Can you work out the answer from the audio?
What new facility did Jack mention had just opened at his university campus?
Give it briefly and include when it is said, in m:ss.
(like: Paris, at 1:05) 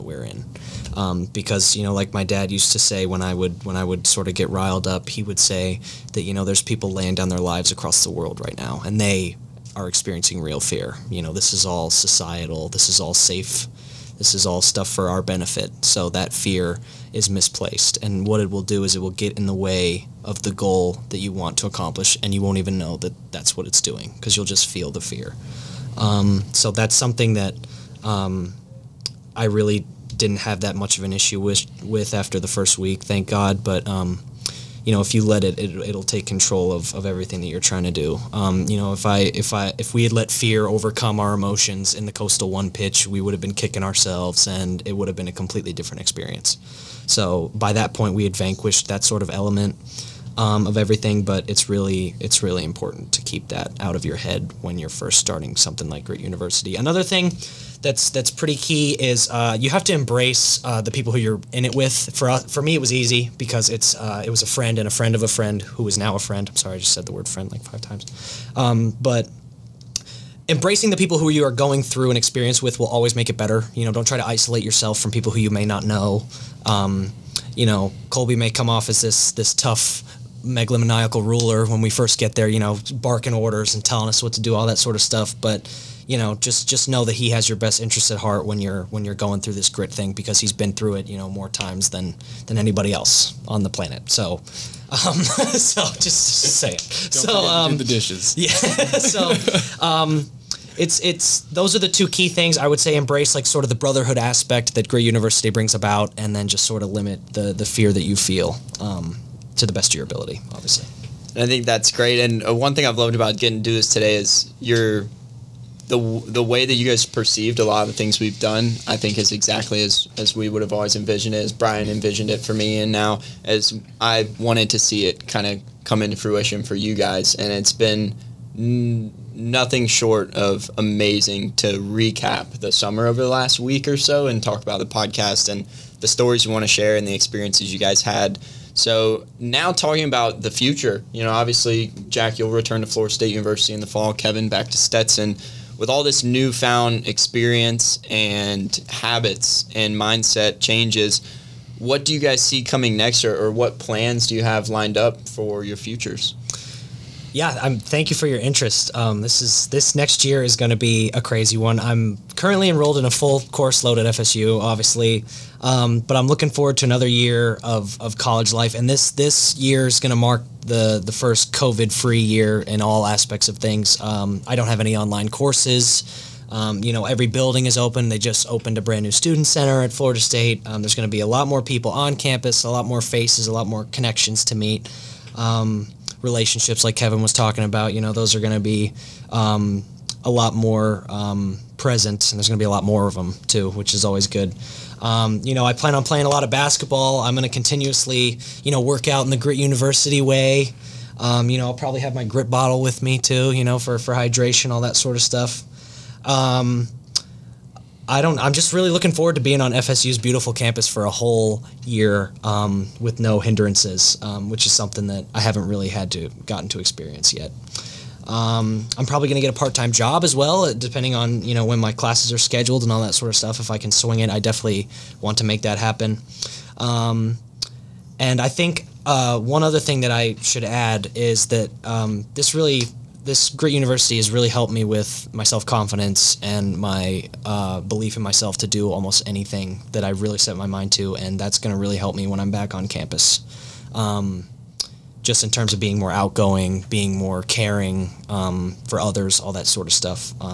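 student center, at 2:59.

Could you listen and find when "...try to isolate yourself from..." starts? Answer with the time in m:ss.
1:14.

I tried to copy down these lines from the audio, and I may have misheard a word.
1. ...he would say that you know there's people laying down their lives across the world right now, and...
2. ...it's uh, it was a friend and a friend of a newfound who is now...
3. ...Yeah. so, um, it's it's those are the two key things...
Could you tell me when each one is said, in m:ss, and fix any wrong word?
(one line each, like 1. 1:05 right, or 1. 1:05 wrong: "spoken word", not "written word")
1. 0:05 right
2. 1:03 wrong: "friend", not "newfound"
3. 1:38 right.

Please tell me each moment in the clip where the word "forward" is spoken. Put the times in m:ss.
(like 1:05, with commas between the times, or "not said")
2:46, 3:29.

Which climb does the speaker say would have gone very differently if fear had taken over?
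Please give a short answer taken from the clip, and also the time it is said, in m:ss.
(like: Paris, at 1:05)
coastal one pitch, at 0:42.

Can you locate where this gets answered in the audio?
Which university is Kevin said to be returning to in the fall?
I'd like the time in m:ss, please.
2:24.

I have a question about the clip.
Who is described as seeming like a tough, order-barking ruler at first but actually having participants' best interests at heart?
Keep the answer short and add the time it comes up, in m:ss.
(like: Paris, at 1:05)
Colby, at 1:18.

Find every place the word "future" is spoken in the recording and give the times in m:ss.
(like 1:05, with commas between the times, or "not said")
2:20, 2:35.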